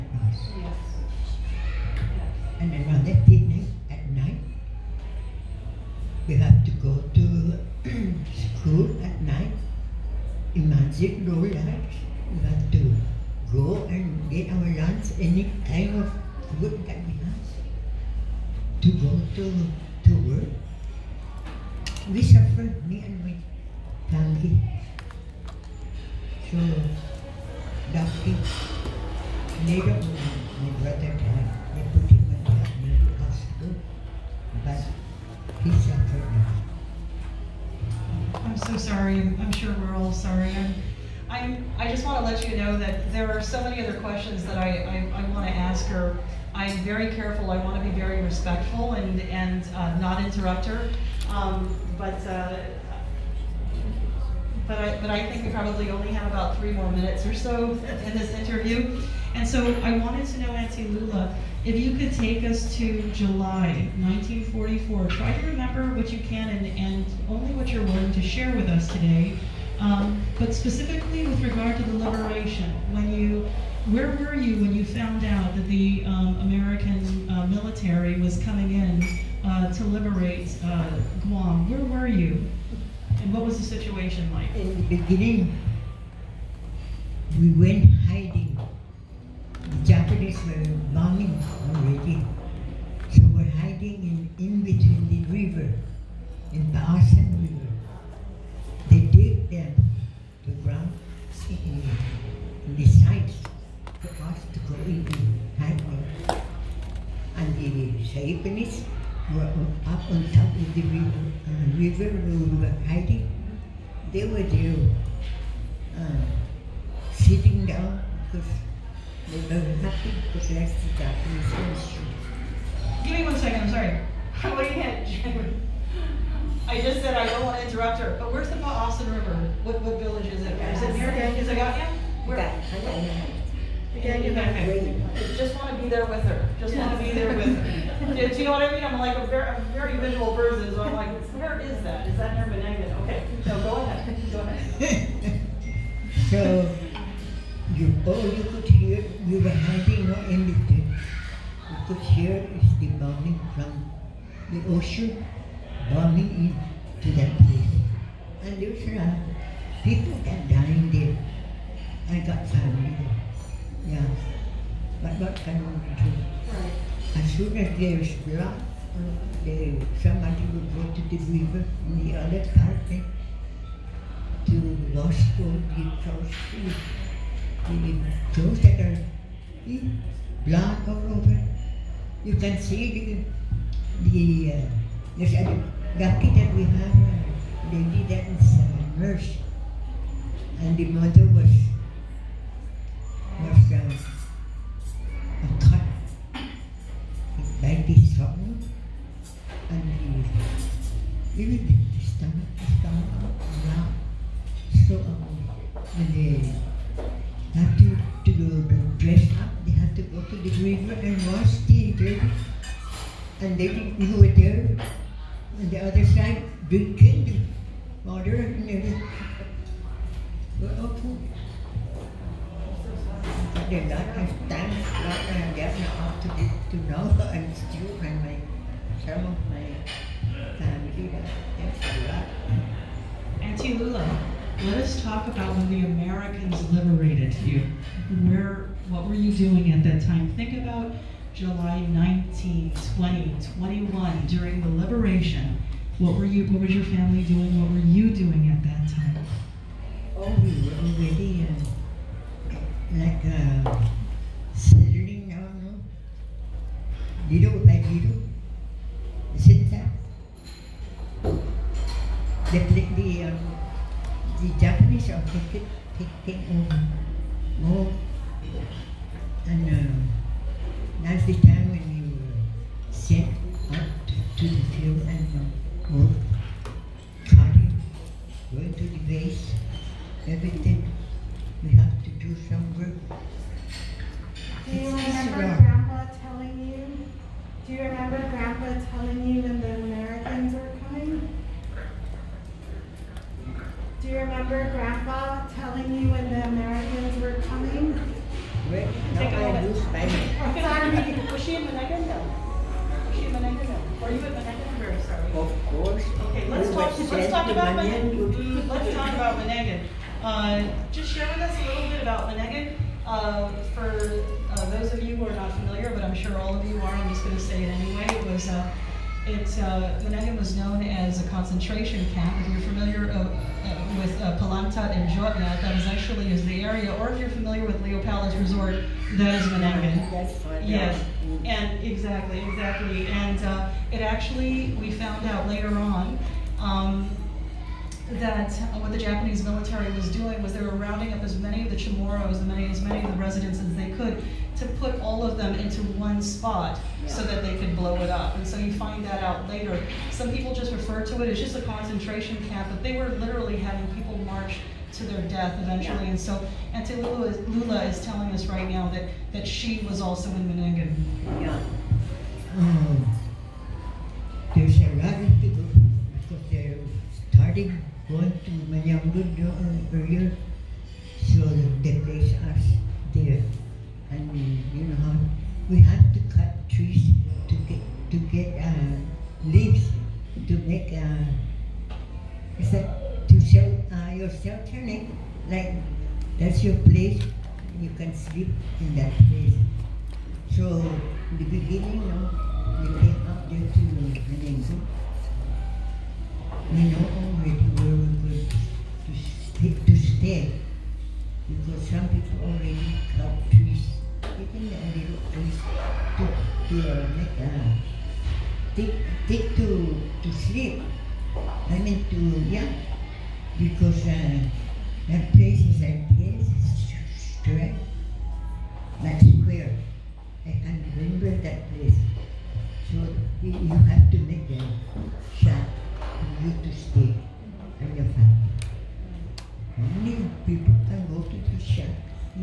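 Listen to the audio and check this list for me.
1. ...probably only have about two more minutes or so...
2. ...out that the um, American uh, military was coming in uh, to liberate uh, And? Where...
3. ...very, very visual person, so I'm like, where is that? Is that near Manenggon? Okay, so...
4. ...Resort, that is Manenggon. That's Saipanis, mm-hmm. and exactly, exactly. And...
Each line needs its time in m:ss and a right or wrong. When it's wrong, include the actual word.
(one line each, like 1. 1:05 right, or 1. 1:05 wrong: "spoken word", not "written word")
1. 0:55 wrong: "three", not "two"
2. 1:15 wrong: "Guam", not "And"
3. 2:19 right
4. 5:28 wrong: "Yes", not "Saipanis".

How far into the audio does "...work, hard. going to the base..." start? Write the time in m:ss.
4:35.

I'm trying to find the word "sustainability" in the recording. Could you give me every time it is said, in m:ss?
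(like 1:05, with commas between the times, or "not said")
not said.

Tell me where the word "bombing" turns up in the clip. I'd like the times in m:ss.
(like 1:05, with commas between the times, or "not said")
1:30.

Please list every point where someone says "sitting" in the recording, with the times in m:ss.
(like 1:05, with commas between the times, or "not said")
1:57, 4:14.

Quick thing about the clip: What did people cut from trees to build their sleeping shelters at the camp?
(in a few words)
Leaves.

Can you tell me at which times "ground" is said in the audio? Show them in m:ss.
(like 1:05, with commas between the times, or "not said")
1:40.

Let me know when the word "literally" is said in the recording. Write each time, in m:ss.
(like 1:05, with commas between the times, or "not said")
5:53.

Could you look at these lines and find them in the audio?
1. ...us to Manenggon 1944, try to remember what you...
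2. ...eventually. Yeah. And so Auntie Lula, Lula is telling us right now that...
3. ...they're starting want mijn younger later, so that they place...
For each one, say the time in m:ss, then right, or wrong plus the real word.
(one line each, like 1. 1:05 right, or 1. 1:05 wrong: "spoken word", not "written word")
1. 1:02 wrong: "July", not "Manenggon"
2. 5:55 right
3. 6:06 wrong: "earlier", not "later".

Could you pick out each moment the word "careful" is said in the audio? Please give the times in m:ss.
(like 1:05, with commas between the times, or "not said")
0:47.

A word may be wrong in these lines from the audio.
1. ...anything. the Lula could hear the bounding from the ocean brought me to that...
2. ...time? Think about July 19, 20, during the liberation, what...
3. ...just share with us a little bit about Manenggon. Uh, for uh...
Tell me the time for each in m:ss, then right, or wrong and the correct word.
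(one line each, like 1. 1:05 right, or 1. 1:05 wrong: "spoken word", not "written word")
1. 2:30 wrong: "You", not "Lula"
2. 4:00 right
3. 5:10 right.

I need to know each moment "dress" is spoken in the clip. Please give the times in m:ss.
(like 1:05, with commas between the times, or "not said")
3:29.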